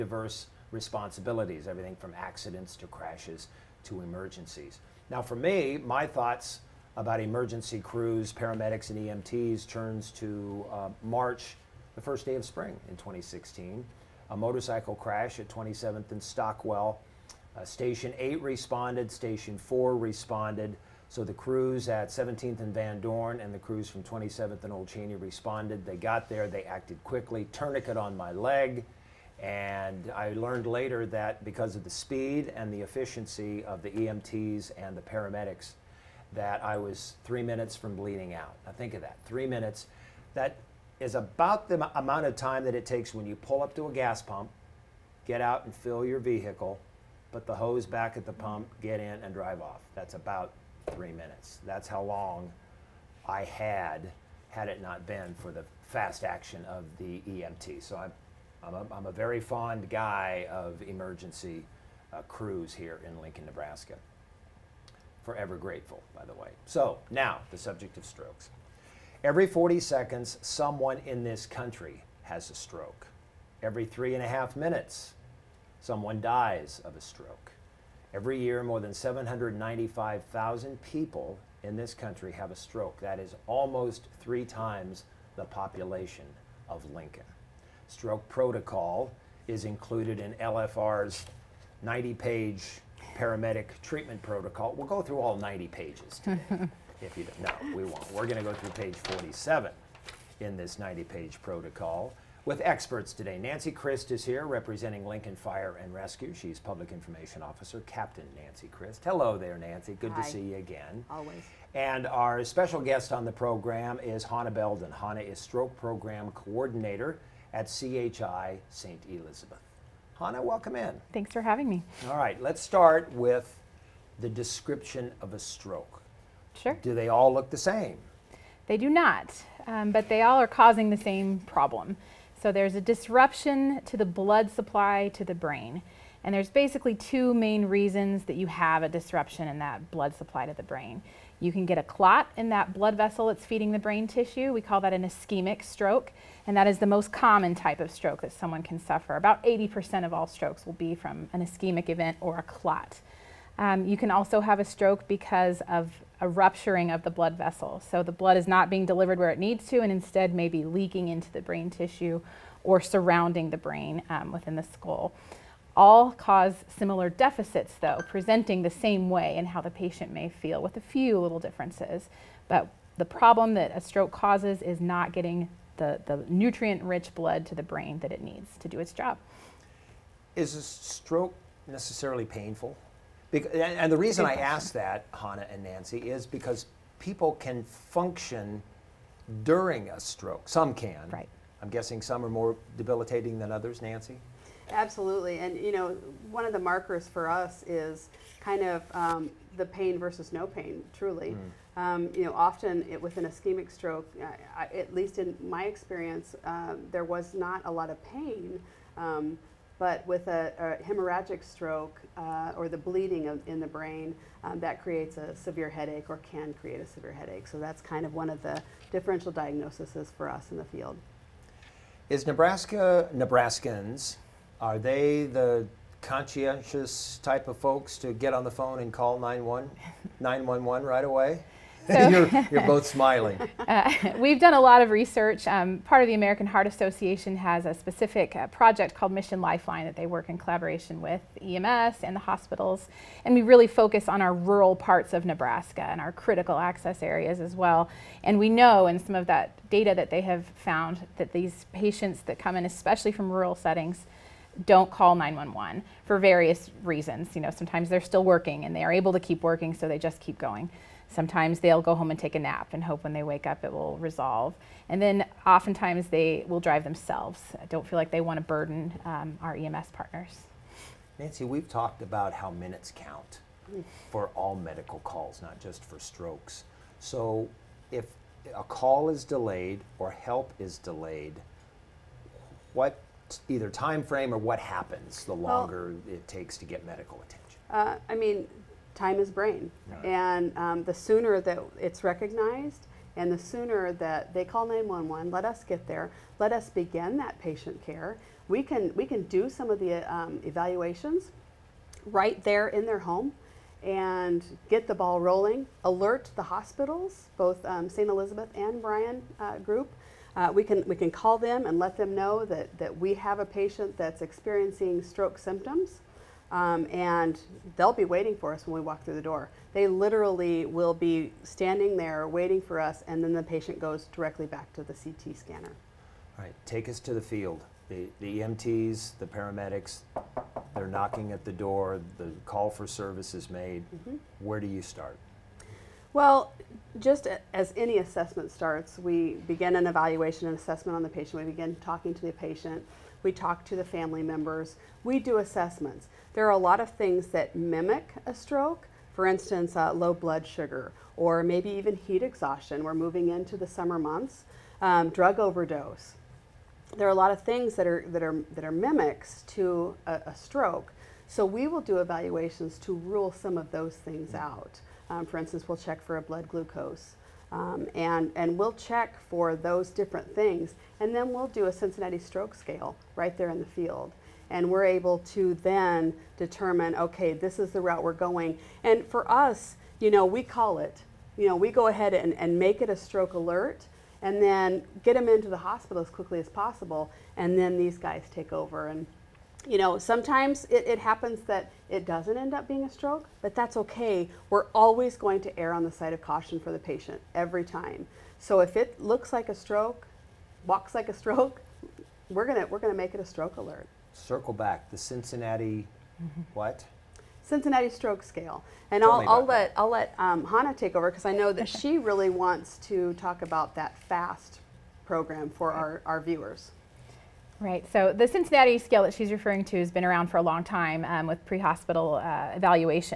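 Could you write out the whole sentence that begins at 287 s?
Uh, I mean, time is brain.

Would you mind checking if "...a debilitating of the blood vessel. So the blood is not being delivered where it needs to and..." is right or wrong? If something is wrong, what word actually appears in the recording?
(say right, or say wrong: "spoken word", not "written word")
wrong: "rupturing", not "debilitating".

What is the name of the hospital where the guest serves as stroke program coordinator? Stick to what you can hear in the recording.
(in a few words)
CHI St. Elizabeth.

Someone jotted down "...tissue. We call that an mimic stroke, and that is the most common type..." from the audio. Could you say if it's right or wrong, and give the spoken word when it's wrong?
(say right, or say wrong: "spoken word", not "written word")
wrong: "ischemic", not "mimic".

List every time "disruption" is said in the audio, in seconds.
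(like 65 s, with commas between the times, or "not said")
132 s, 138 s.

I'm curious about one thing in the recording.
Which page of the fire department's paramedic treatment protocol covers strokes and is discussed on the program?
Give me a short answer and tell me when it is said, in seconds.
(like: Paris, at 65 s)
Page 47, at 98 s.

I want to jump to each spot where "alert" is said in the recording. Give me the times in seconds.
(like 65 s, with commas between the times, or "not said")
305 s, 383 s, 403 s.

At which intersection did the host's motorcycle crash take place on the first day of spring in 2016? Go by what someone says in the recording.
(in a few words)
27th and Stockwell.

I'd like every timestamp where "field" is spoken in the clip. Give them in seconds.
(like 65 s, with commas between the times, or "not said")
220 s, 327 s, 373 s.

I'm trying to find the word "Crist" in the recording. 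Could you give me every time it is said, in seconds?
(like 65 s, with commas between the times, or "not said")
103 s, 108 s.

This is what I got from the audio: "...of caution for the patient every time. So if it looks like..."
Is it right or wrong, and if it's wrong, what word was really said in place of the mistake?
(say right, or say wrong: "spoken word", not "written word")
right.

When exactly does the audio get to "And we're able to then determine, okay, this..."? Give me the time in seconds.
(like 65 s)
374 s.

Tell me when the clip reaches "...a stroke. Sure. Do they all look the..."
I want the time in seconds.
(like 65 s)
125 s.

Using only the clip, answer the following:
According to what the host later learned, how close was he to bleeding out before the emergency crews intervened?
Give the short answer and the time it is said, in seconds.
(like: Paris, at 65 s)
3 minutes, at 37 s.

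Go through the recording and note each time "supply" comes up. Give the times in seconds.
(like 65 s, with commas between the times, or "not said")
134 s, 140 s.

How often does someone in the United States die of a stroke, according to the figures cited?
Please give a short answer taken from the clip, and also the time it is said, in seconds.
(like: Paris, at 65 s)
Every 3.5 minutes, at 73 s.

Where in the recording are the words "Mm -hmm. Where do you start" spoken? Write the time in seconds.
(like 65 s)
333 s.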